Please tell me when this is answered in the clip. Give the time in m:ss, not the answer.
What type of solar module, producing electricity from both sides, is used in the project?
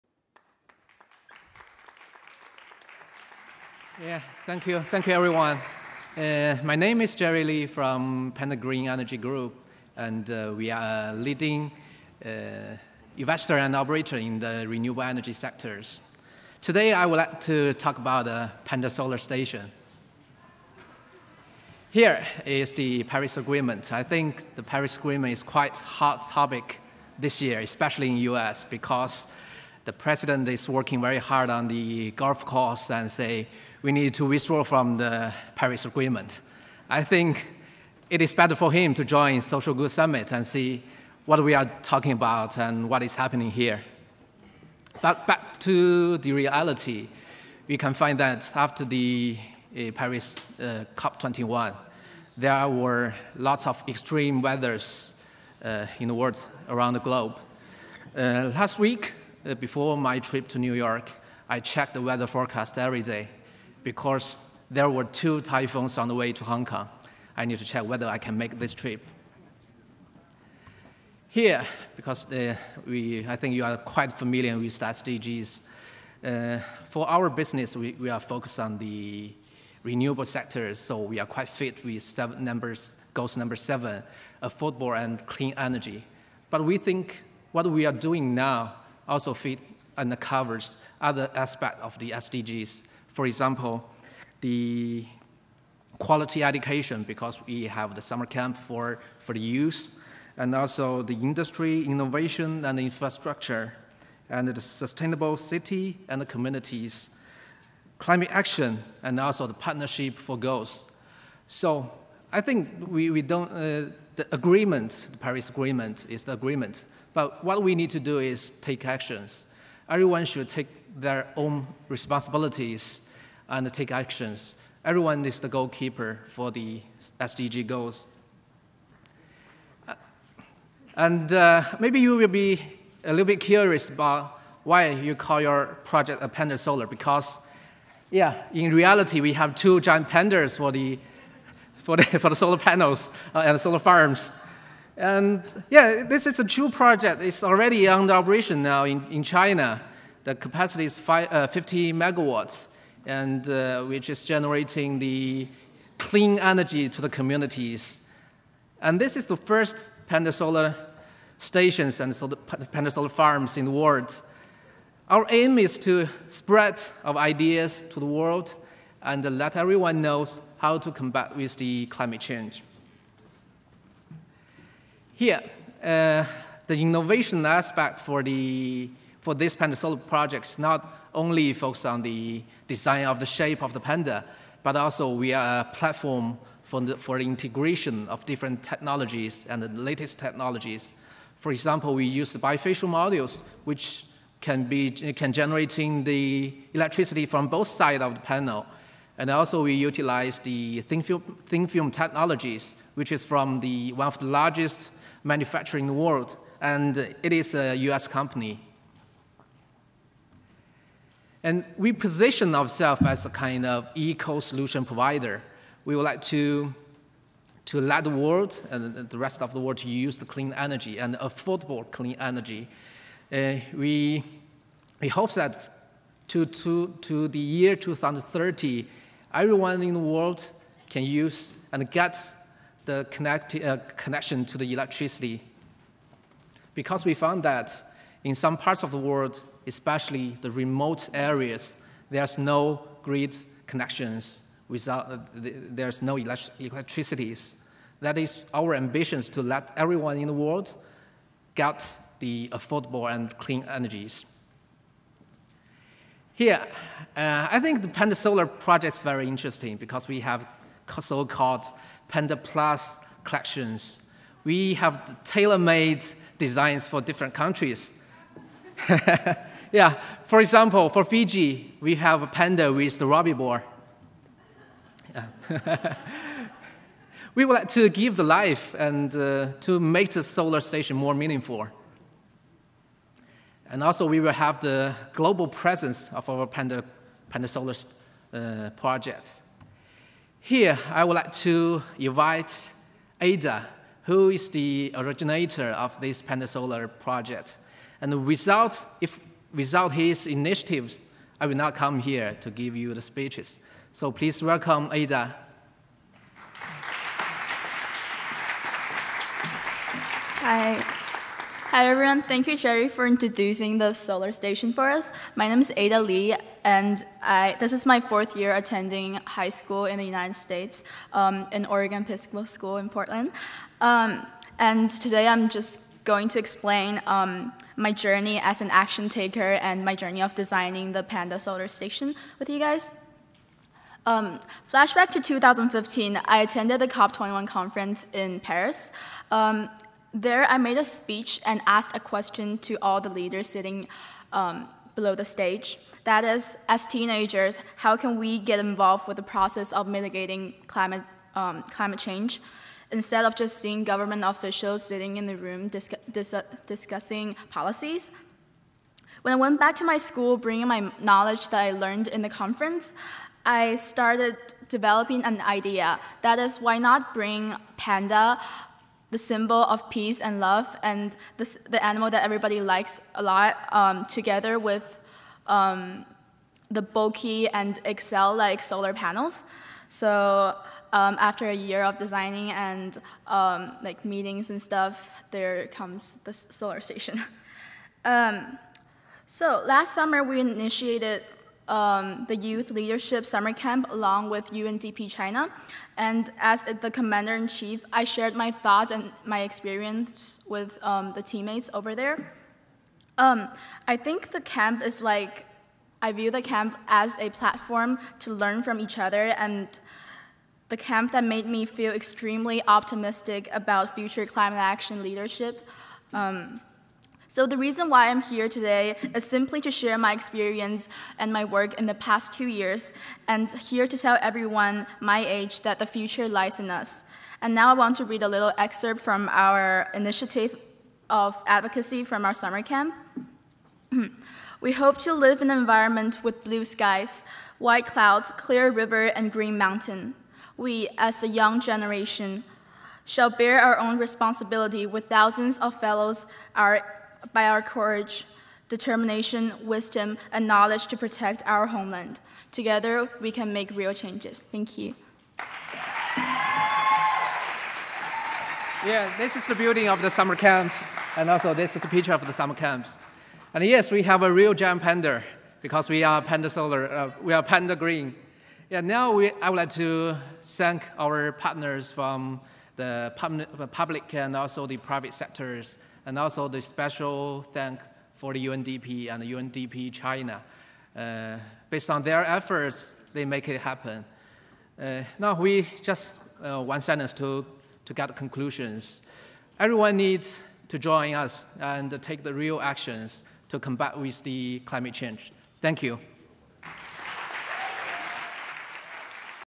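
3:12.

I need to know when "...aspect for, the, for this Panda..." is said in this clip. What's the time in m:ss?
2:57.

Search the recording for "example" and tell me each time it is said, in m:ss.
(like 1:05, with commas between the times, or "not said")
1:33, 3:11, 4:30.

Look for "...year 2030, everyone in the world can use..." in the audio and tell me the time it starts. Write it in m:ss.
3:47.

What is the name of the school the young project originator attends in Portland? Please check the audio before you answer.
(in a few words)
Oregon Episcopal School.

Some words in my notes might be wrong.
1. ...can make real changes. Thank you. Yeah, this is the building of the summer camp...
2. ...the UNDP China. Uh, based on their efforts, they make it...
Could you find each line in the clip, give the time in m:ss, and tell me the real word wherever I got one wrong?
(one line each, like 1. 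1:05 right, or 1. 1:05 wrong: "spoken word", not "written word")
1. 7:33 right
2. 7:59 right.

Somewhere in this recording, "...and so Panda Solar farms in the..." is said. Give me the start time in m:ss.
2:41.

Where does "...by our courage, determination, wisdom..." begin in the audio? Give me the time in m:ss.
7:27.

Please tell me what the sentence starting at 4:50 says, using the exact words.
Here, I would like to invite Ada, who is the originator of this pan-solar project.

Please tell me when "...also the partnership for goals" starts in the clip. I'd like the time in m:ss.
1:49.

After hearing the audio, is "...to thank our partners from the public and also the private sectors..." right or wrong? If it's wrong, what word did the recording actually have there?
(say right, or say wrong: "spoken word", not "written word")
right.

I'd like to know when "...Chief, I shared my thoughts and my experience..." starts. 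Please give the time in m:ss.
6:37.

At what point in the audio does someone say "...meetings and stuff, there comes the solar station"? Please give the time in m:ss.
6:24.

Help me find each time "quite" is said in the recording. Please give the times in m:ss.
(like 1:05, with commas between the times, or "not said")
0:25, 1:13, 1:21.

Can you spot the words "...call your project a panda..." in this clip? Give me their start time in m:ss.
2:15.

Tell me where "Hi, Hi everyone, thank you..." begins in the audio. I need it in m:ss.
5:10.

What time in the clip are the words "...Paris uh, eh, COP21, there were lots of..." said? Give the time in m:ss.
0:49.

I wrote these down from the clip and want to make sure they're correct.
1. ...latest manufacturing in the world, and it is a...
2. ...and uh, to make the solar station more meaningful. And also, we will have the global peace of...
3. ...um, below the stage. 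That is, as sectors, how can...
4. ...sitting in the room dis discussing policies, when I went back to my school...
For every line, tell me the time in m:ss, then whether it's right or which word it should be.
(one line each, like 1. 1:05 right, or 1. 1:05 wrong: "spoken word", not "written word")
1. 3:24 wrong: "largest", not "latest"
2. 4:38 wrong: "presence", not "peace"
3. 5:44 wrong: "teenagers", not "sectors"
4. 5:54 right.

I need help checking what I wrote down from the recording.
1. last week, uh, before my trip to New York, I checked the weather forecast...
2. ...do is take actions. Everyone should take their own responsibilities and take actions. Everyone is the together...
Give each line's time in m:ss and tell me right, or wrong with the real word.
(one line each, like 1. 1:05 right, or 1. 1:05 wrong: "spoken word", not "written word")
1. 0:58 right
2. 1:57 wrong: "goalkeeper", not "together".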